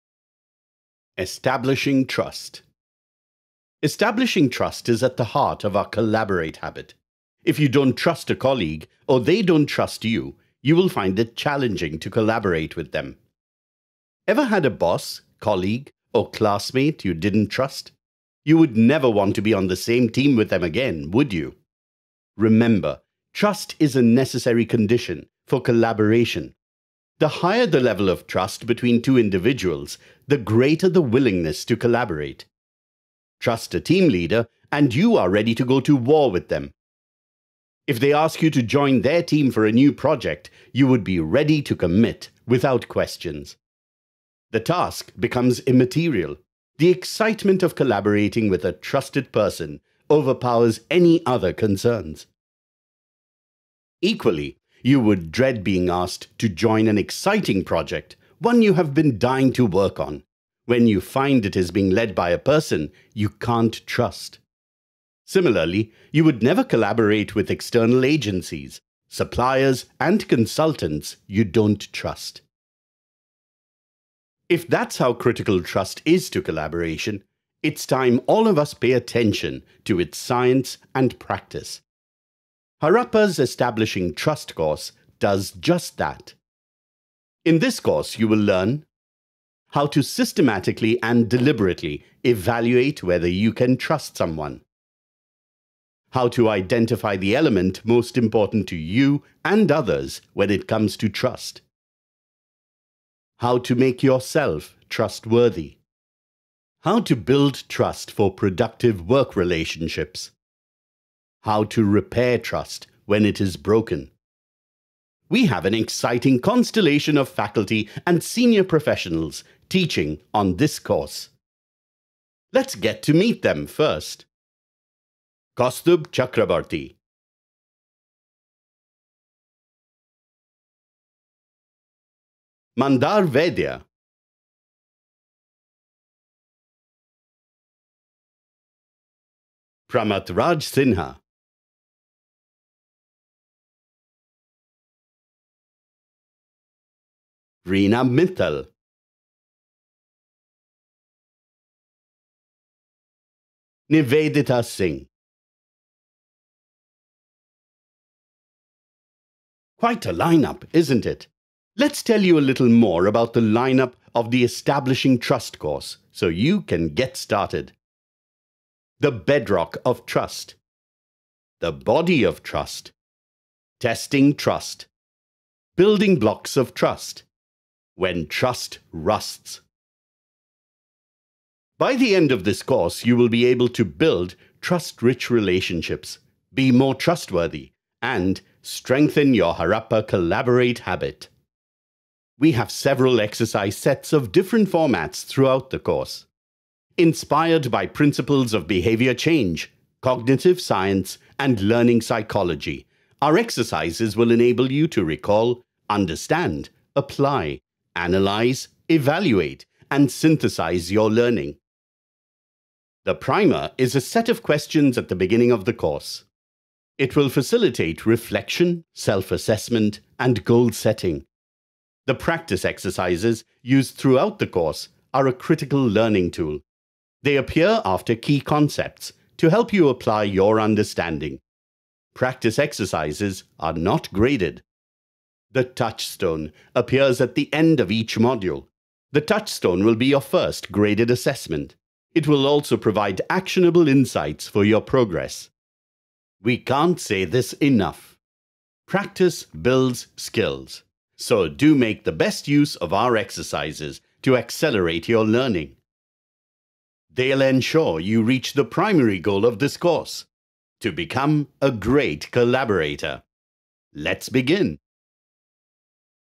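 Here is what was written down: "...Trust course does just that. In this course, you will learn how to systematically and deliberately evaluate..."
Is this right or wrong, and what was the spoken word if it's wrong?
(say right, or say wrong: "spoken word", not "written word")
right.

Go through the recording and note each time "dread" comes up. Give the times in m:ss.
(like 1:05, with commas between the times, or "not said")
0:55.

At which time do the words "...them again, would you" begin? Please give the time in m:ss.
0:20.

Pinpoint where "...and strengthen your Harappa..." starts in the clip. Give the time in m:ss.
3:08.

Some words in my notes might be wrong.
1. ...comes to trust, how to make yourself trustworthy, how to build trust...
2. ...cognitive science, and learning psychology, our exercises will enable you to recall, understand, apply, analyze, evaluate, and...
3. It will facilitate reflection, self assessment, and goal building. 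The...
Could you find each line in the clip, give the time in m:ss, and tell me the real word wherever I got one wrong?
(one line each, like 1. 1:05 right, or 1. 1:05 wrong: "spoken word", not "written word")
1. 1:40 right
2. 3:20 right
3. 3:36 wrong: "setting", not "building".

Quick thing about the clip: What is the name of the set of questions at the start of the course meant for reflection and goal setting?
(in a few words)
The primer.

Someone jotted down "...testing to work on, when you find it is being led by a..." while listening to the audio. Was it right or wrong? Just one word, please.
wrong.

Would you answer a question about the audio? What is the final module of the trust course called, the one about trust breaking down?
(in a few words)
When Trust Rusts.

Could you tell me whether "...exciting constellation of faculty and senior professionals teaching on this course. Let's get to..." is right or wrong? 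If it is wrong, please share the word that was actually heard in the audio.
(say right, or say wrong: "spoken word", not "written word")
right.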